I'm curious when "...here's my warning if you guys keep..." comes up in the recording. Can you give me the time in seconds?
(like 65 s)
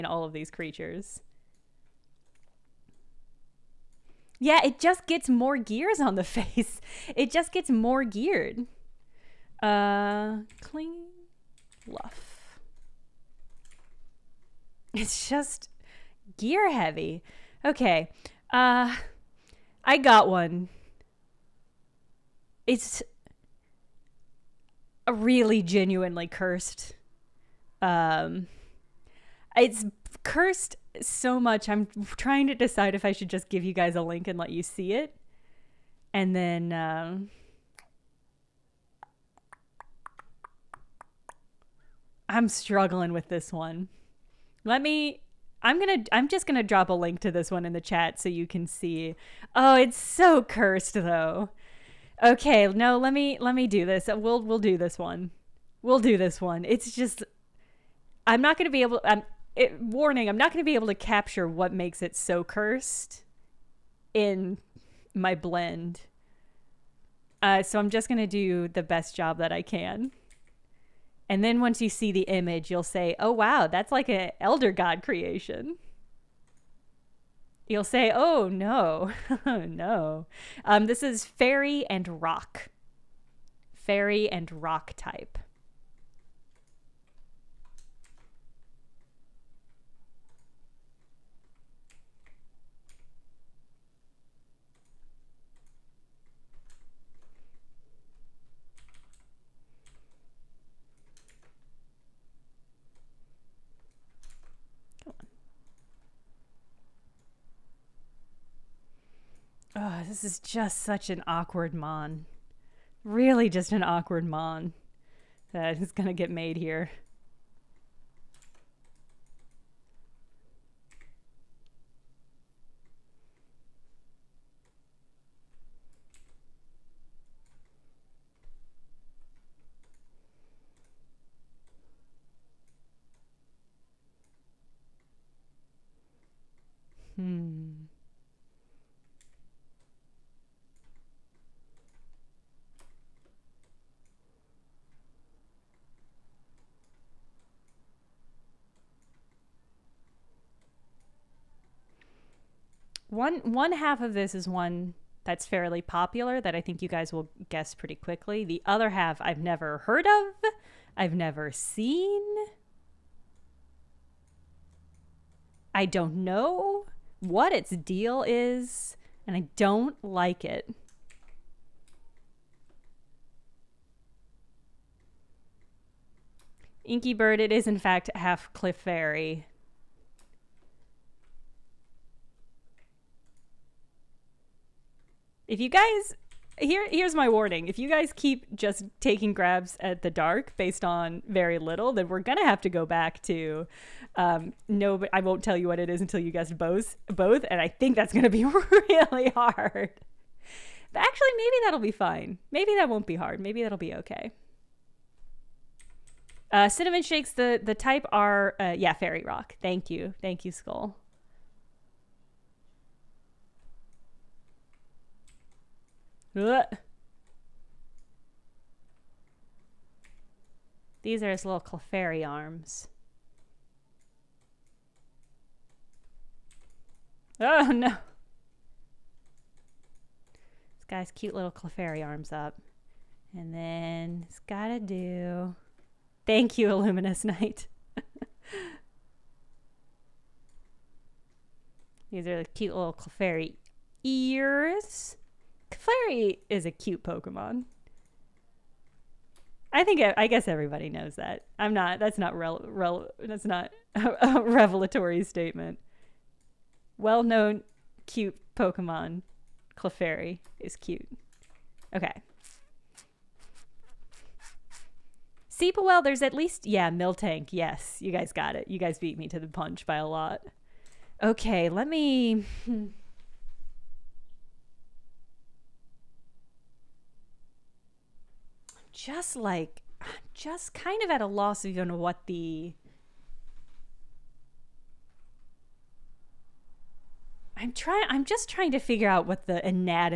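186 s.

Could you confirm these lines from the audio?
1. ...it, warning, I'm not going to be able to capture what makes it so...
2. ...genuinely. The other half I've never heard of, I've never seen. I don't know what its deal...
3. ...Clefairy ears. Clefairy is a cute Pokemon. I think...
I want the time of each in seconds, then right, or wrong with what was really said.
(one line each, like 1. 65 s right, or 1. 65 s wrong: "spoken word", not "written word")
1. 59 s right
2. 157 s wrong: "quickly", not "genuinely"
3. 242 s right.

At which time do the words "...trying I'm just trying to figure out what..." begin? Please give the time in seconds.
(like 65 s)
287 s.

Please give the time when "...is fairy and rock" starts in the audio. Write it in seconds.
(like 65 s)
81 s.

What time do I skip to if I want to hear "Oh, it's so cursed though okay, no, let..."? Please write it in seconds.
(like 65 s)
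49 s.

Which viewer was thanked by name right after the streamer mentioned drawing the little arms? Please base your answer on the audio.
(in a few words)
Illuminous Knight.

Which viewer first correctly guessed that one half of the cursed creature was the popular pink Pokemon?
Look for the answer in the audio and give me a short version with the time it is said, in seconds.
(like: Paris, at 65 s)
Inky Bird, at 176 s.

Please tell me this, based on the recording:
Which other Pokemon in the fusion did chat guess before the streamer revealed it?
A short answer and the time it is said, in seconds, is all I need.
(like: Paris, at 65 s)
Miltank, at 266 s.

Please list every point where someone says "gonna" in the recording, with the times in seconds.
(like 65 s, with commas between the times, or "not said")
192 s, 198 s.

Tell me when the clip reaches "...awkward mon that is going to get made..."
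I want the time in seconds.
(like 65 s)
113 s.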